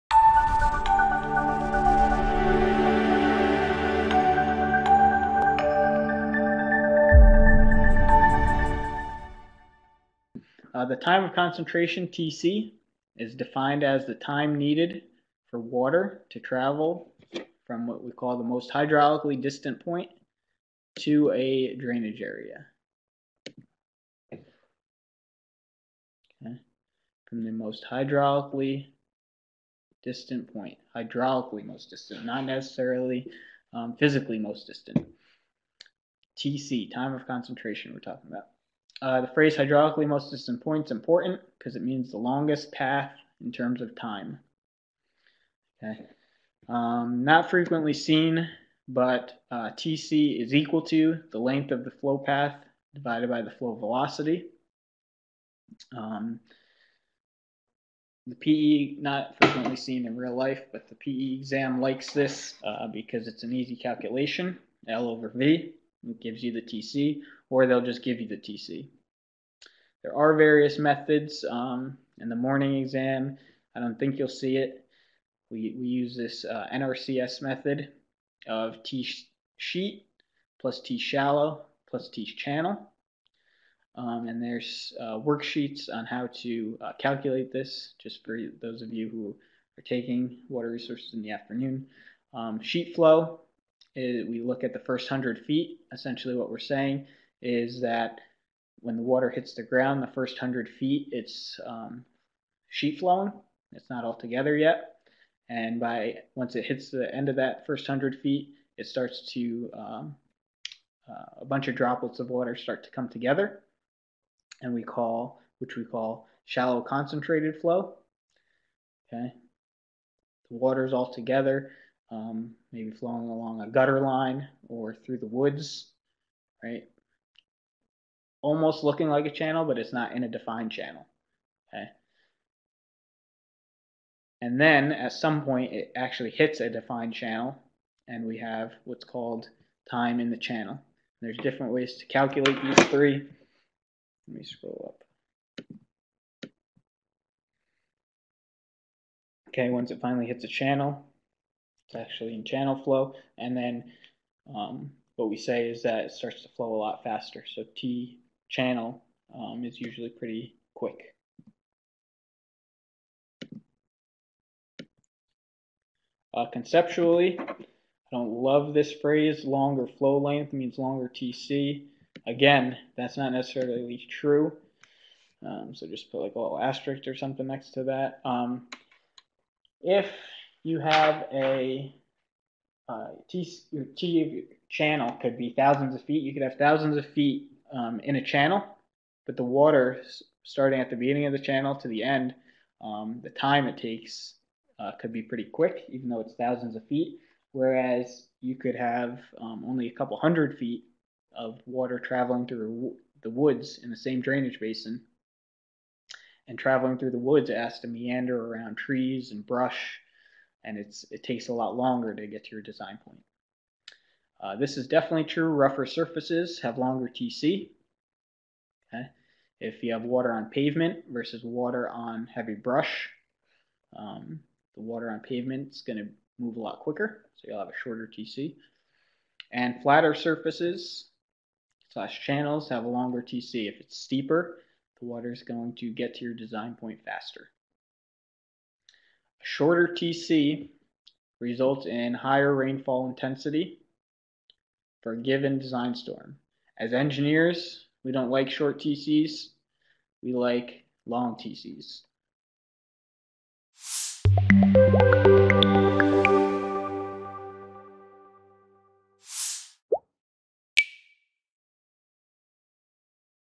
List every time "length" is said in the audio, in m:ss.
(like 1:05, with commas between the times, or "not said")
0:51, 2:50.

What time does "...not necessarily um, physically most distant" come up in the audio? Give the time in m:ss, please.
0:32.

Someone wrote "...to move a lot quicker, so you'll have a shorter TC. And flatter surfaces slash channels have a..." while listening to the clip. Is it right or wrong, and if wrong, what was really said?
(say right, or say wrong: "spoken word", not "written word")
right.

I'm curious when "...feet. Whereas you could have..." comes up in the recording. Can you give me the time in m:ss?
3:16.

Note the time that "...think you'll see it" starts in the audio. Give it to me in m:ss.
1:13.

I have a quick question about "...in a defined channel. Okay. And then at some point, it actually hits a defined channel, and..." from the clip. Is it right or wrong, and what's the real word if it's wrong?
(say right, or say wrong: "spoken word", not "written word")
right.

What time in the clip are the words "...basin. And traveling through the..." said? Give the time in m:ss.
3:24.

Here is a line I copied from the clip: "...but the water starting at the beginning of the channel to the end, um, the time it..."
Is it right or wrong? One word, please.
right.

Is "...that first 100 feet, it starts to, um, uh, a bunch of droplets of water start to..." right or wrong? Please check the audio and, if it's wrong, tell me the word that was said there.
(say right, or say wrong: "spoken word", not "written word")
right.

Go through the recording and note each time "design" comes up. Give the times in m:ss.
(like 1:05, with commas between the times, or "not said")
3:32, 3:56, 4:05.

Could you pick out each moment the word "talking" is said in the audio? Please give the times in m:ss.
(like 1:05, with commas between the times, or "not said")
0:37.